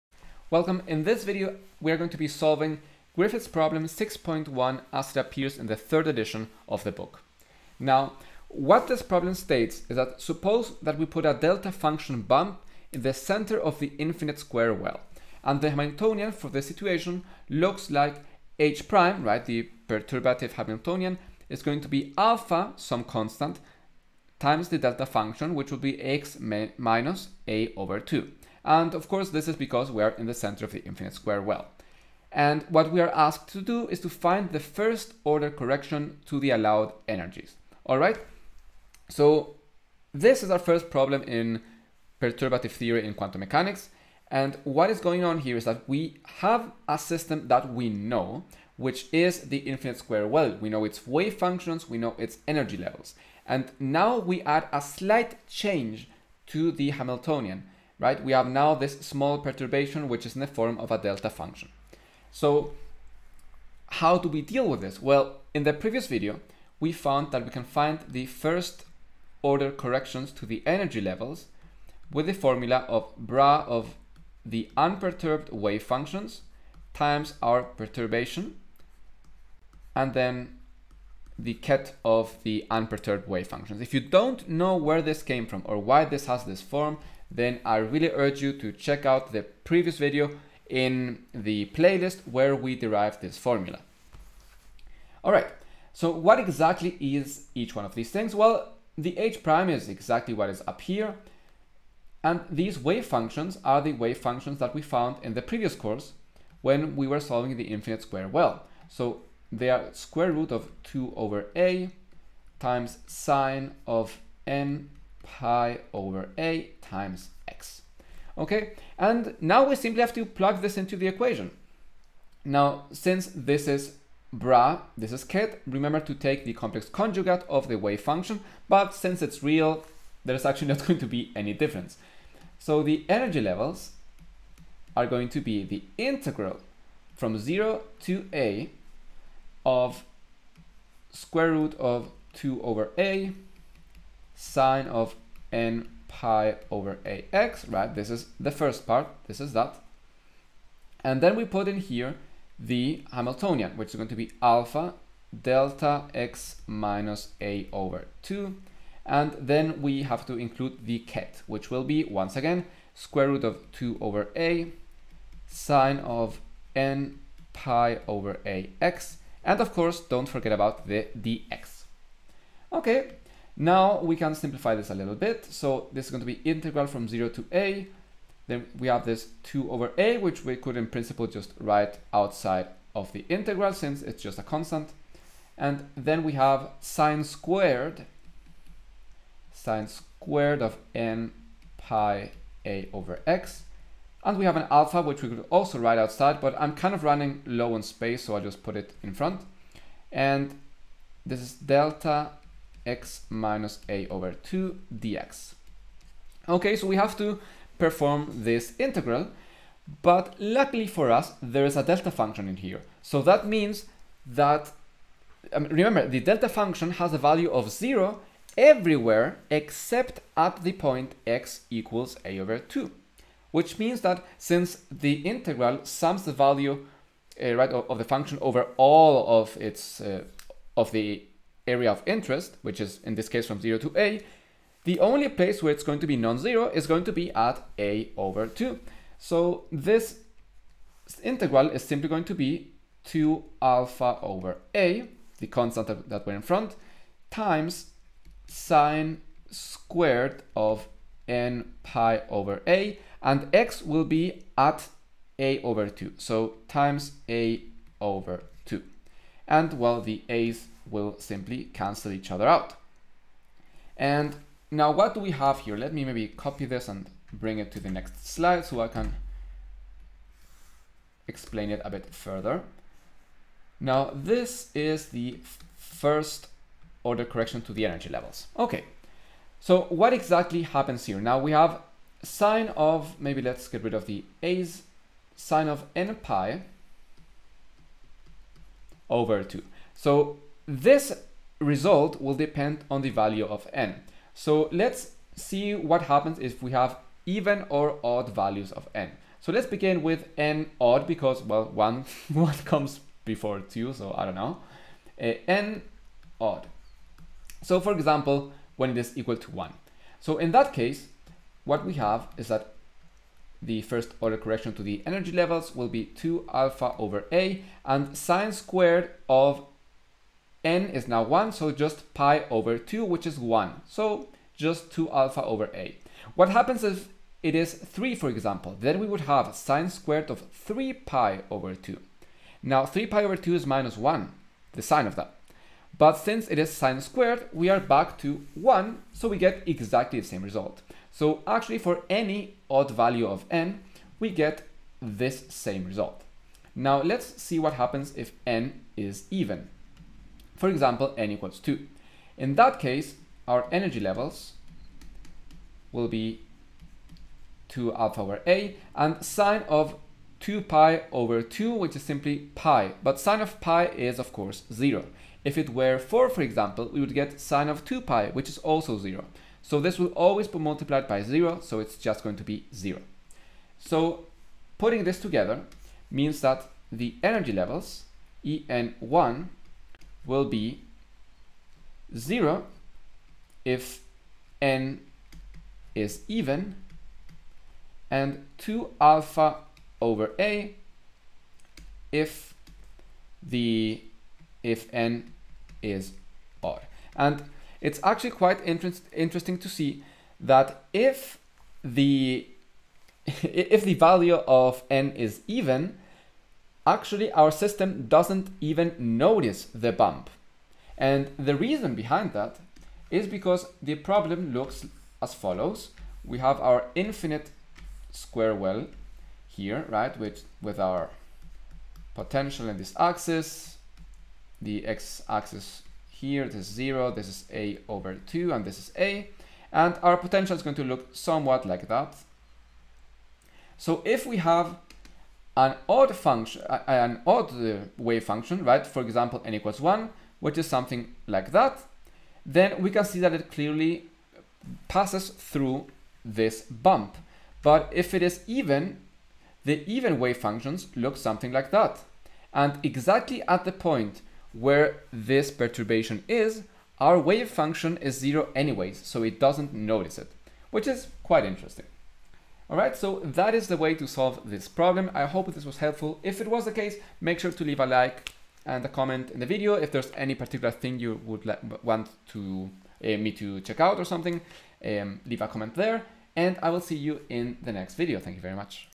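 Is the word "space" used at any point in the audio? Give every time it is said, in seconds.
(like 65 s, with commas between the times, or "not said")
197 s.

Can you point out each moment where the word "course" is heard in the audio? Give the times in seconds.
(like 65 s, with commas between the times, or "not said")
29 s, 105 s, 169 s, 364 s.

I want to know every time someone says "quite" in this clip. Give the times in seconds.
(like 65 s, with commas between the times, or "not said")
398 s, 461 s.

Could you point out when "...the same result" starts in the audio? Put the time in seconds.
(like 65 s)
340 s.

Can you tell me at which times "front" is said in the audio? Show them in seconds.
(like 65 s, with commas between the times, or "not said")
199 s, 246 s.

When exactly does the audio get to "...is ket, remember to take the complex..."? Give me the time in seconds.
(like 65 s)
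125 s.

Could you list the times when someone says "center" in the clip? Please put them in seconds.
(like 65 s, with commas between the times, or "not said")
13 s, 30 s.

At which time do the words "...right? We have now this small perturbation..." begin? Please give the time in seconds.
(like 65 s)
58 s.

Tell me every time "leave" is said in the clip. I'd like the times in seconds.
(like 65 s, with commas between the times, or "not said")
467 s, 475 s.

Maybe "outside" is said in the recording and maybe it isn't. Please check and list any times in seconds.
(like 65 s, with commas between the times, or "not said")
182 s, 195 s.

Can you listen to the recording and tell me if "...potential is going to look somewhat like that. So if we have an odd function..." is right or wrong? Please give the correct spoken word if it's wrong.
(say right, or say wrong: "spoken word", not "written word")
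right.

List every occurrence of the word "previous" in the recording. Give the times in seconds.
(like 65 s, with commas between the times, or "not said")
65 s, 89 s, 105 s.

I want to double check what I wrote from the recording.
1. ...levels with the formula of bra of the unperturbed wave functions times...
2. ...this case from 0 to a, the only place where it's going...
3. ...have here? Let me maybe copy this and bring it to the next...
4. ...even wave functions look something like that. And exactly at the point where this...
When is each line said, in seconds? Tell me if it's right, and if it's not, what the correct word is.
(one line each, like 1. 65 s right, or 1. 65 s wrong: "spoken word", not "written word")
1. 70 s right
2. 233 s right
3. 265 s right
4. 449 s right.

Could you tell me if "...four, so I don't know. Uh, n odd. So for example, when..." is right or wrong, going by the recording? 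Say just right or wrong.
wrong.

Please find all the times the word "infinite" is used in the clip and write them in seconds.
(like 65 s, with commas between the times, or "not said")
13 s, 30 s, 49 s, 107 s, 416 s.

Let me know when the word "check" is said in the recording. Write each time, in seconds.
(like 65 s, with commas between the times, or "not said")
88 s, 473 s.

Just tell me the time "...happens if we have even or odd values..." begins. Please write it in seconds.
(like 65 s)
296 s.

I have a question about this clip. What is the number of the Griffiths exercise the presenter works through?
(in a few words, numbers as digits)
6.1.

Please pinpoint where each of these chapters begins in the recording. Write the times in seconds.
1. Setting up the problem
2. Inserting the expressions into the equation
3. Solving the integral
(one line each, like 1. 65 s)
1. 60 s
2. 90 s
3. 171 s.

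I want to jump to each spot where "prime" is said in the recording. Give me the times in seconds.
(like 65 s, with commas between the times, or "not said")
18 s, 99 s.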